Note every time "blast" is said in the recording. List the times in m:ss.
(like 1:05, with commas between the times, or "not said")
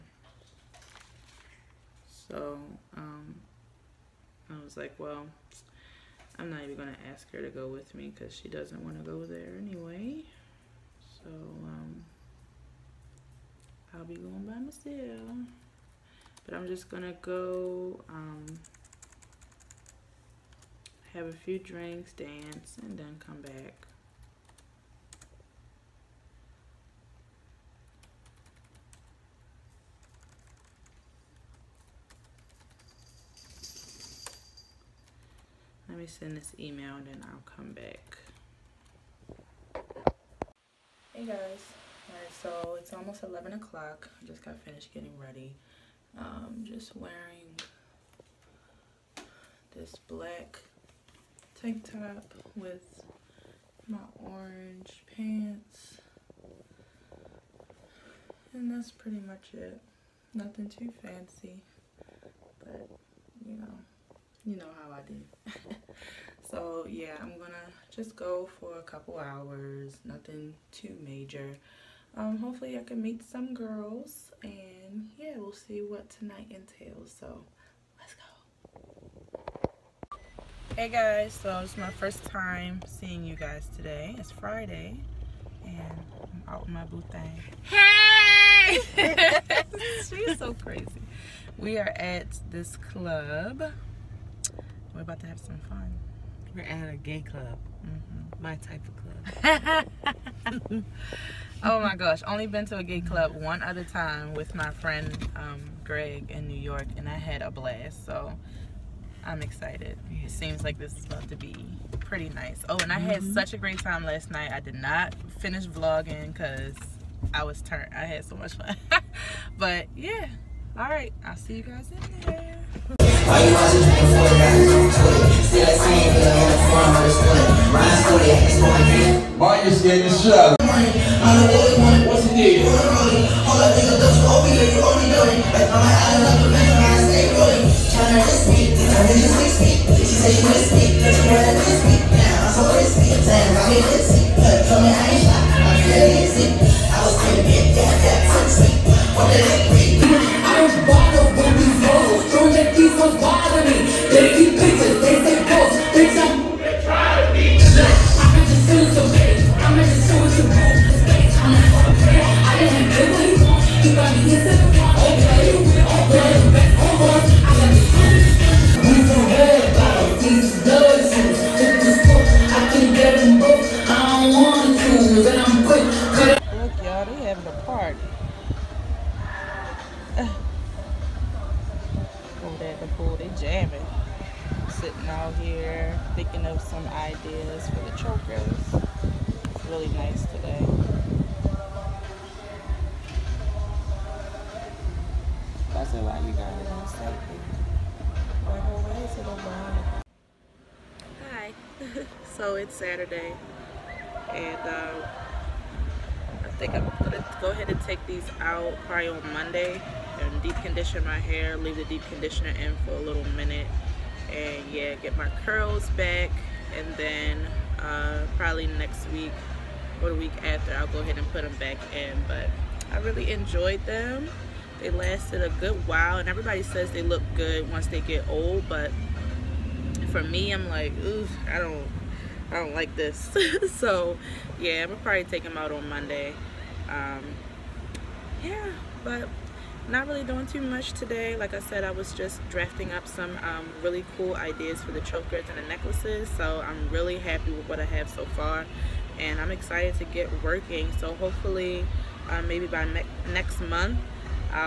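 1:47.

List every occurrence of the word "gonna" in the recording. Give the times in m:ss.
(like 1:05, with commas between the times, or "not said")
0:16, 1:07, 3:27, 3:54.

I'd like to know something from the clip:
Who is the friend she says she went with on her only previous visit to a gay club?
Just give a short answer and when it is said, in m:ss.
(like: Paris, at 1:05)
Greg, at 1:45.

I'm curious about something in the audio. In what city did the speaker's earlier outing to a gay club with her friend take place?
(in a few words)
New York.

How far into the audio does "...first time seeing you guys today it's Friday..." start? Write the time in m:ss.
1:21.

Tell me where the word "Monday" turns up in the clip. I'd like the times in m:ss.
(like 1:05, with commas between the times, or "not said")
3:29, 3:55.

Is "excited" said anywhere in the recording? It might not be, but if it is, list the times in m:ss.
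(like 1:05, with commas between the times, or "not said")
1:49, 4:09.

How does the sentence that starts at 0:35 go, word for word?
Let me send this email and then I'll come back.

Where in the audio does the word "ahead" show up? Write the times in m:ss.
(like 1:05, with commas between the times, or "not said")
3:27, 3:40.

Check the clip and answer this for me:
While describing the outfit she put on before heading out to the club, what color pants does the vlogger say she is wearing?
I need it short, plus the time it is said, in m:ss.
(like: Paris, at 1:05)
Orange, at 0:54.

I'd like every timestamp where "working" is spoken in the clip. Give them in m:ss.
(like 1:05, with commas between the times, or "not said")
4:10.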